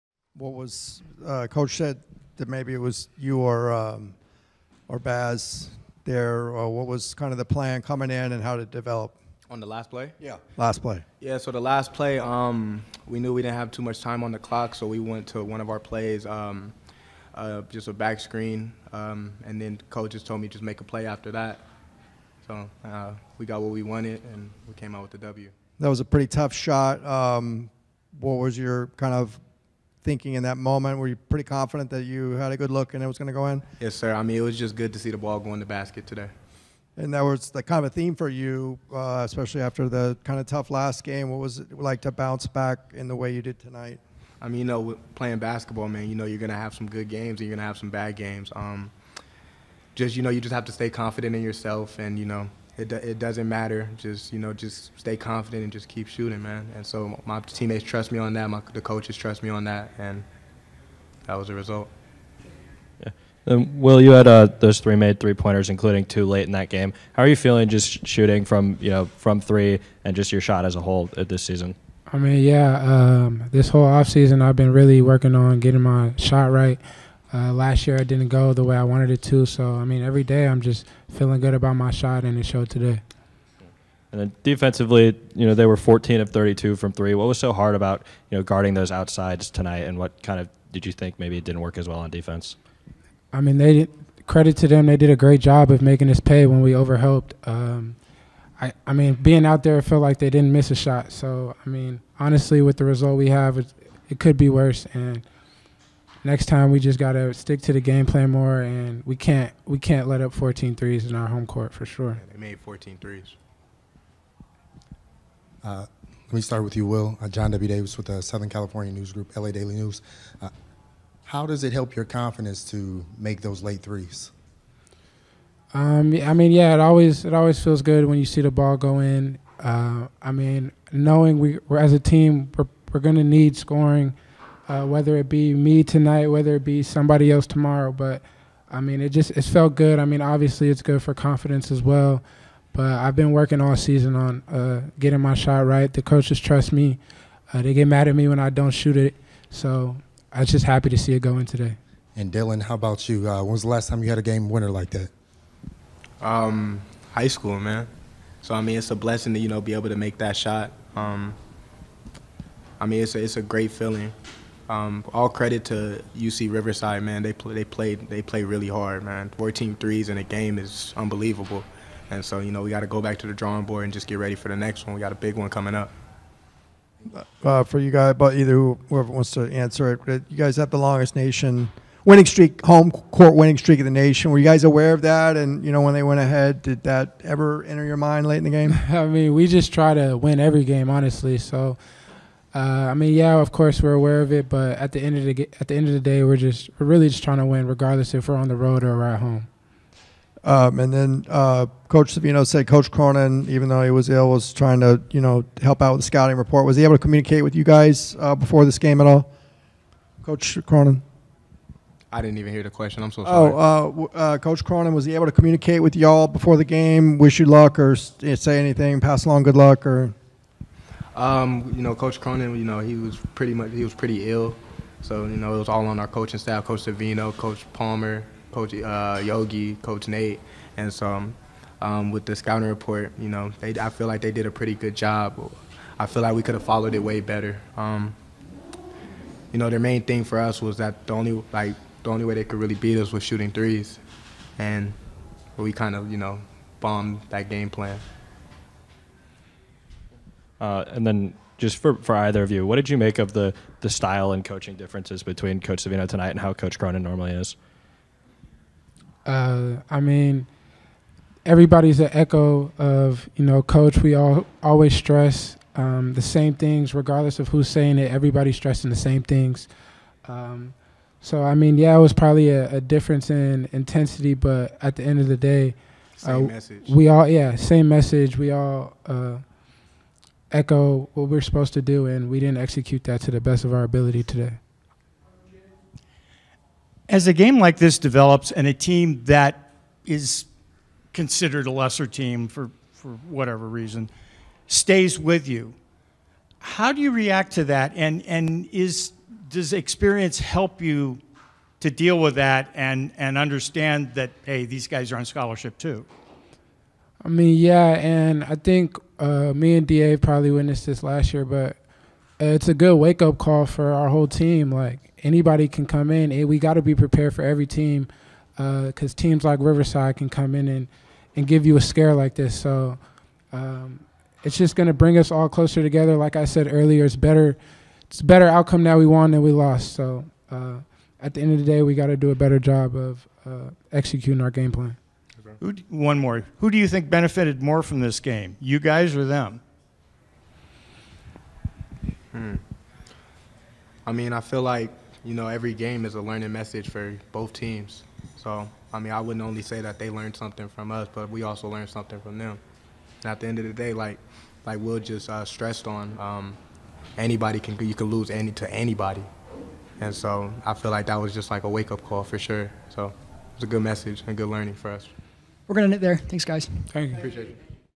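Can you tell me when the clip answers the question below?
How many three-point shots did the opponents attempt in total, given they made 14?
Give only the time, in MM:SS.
01:25.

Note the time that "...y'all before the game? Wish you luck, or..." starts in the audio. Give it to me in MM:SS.
03:35.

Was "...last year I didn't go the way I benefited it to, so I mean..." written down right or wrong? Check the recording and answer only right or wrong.
wrong.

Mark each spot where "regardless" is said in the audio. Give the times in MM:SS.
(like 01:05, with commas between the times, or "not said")
03:17, 04:26.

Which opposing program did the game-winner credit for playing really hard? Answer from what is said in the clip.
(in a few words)
UC Riverside.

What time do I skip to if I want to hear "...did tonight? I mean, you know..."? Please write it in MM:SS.
00:43.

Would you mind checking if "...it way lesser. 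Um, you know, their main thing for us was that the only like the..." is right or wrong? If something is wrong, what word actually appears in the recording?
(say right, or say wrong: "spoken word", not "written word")
wrong: "better", not "lesser".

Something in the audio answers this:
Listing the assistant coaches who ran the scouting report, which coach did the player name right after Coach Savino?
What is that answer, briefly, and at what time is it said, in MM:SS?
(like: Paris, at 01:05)
Coach Palmer, at 03:47.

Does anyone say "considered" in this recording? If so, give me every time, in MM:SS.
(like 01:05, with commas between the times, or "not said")
04:51.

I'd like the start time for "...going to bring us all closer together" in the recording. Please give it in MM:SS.
05:24.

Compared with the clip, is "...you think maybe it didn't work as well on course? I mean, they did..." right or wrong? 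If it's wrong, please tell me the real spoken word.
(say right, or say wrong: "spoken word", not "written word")
wrong: "defense", not "course".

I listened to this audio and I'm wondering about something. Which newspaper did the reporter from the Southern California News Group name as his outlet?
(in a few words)
LA Daily News.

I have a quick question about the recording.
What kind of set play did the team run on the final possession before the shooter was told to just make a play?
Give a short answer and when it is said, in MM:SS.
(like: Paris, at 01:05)
back screen, at 00:17.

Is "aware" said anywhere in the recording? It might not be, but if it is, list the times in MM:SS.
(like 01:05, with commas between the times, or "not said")
03:04, 03:13.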